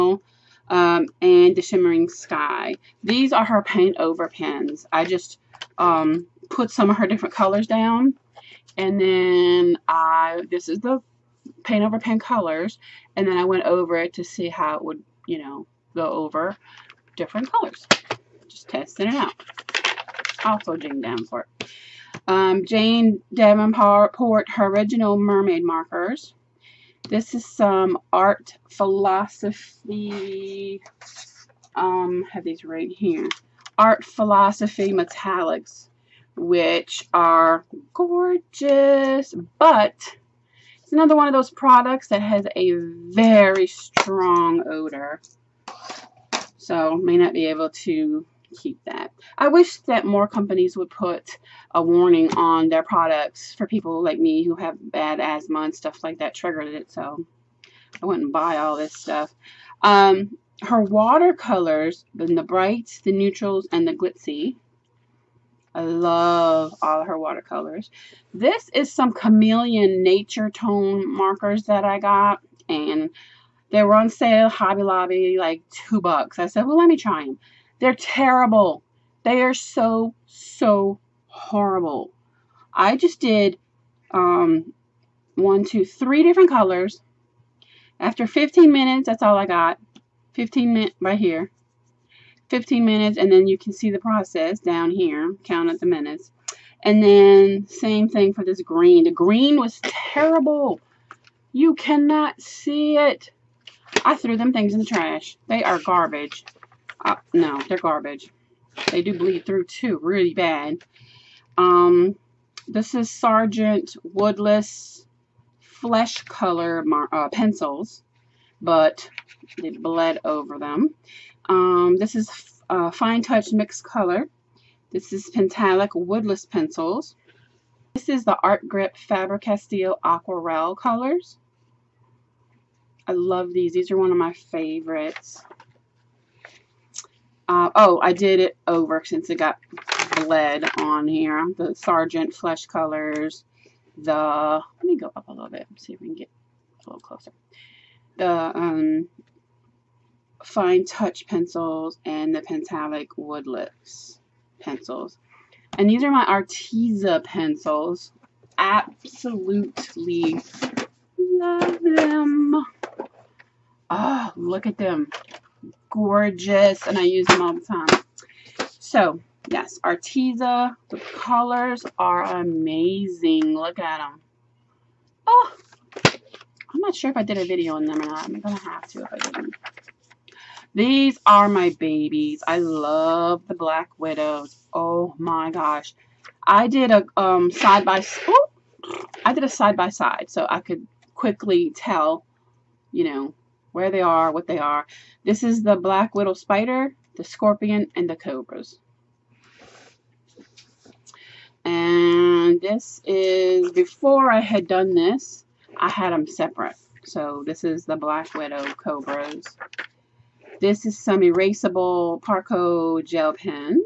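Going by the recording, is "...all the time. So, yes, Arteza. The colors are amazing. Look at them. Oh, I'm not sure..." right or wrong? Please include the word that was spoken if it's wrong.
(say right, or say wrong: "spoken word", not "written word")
right.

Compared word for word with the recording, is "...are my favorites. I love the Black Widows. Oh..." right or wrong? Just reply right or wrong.
wrong.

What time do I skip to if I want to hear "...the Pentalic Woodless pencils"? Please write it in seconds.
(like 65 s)
152 s.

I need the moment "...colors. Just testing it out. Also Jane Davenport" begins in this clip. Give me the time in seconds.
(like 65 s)
17 s.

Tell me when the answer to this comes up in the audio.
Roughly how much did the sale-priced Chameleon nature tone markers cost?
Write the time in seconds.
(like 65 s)
75 s.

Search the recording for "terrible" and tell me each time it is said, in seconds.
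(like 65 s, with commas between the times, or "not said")
77 s, 99 s.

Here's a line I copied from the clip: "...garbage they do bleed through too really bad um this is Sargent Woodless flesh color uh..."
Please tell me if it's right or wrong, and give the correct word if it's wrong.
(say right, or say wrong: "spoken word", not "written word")
right.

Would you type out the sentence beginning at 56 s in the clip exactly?
So I wouldn't buy all this stuff.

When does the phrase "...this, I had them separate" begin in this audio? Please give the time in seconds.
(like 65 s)
204 s.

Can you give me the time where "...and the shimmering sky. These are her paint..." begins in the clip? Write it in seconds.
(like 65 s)
1 s.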